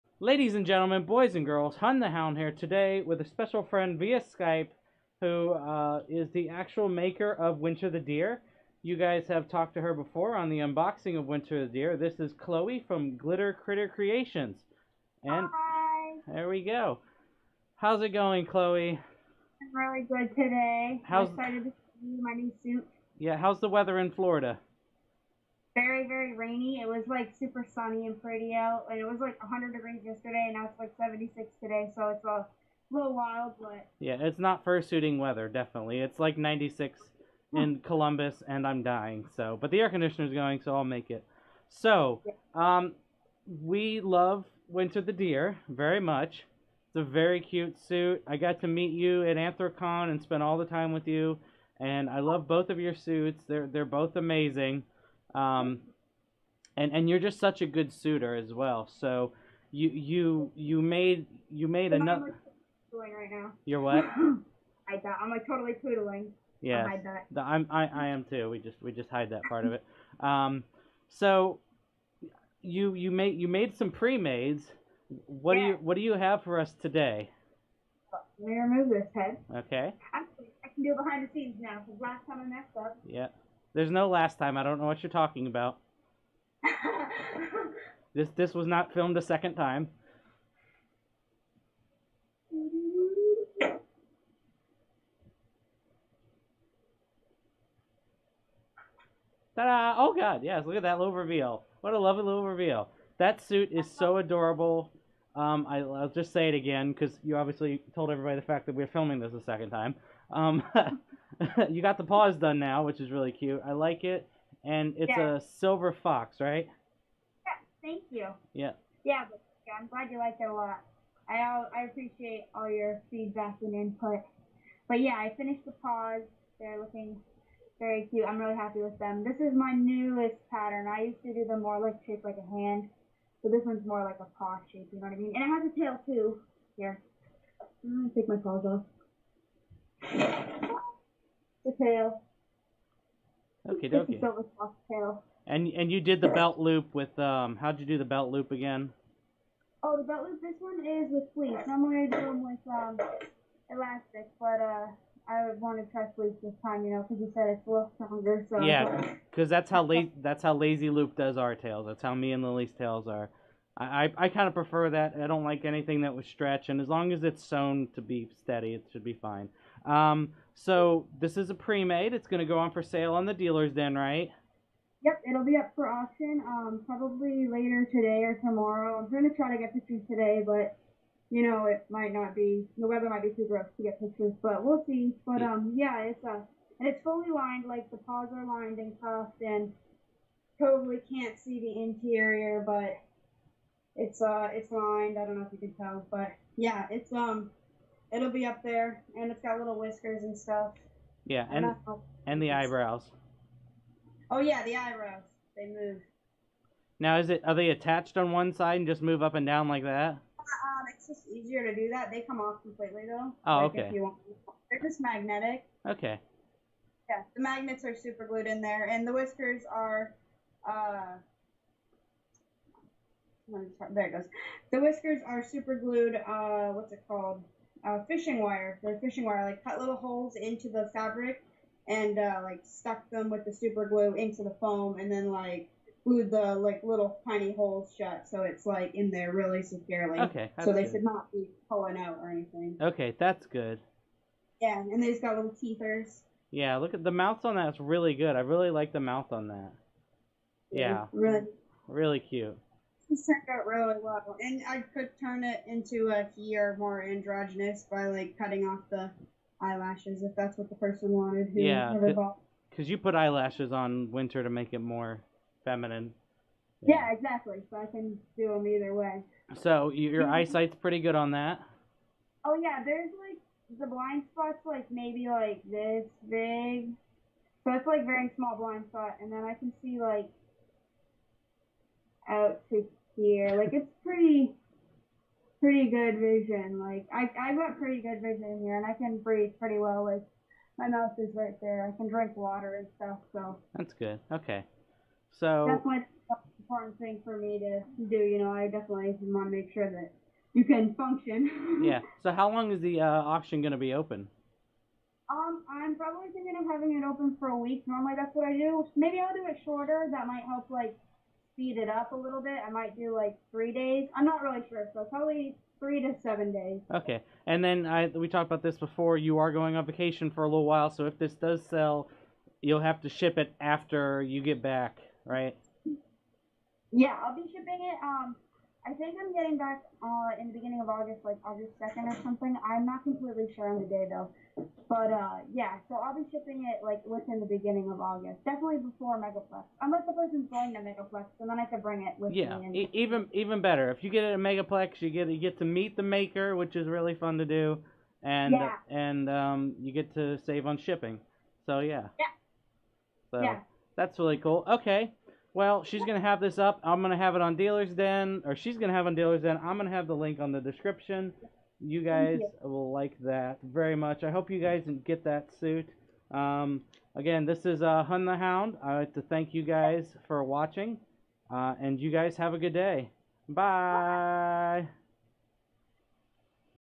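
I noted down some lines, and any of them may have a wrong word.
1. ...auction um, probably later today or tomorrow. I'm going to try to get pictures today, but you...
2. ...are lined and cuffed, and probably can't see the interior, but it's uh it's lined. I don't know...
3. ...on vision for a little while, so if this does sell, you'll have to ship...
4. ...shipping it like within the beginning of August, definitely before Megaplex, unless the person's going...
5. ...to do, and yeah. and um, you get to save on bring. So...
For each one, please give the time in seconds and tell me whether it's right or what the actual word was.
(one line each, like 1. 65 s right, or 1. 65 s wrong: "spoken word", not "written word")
1. 175 s right
2. 188 s right
3. 319 s wrong: "vacation", not "vision"
4. 336 s right
5. 347 s wrong: "shipping", not "bring".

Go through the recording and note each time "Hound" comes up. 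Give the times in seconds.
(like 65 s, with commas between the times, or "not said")
2 s, 368 s.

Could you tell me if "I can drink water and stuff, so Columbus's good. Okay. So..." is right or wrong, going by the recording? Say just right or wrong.
wrong.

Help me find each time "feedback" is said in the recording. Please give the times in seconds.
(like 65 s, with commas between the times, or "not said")
123 s.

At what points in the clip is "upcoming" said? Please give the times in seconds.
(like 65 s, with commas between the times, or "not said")
not said.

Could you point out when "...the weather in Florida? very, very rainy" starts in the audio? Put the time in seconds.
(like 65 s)
23 s.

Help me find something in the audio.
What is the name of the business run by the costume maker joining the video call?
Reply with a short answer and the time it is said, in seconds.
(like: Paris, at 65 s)
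Glitter Critter Creations, at 13 s.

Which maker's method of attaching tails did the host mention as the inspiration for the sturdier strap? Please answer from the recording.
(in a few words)
Lazy Lupe.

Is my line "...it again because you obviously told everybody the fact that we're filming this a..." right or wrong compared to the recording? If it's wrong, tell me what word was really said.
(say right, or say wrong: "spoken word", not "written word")
right.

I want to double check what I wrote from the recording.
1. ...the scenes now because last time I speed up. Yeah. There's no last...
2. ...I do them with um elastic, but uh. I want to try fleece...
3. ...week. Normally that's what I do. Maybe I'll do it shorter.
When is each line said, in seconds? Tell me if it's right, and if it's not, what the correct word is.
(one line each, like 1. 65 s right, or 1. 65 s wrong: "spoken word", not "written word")
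1. 81 s wrong: "messed", not "speed"
2. 152 s right
3. 307 s right.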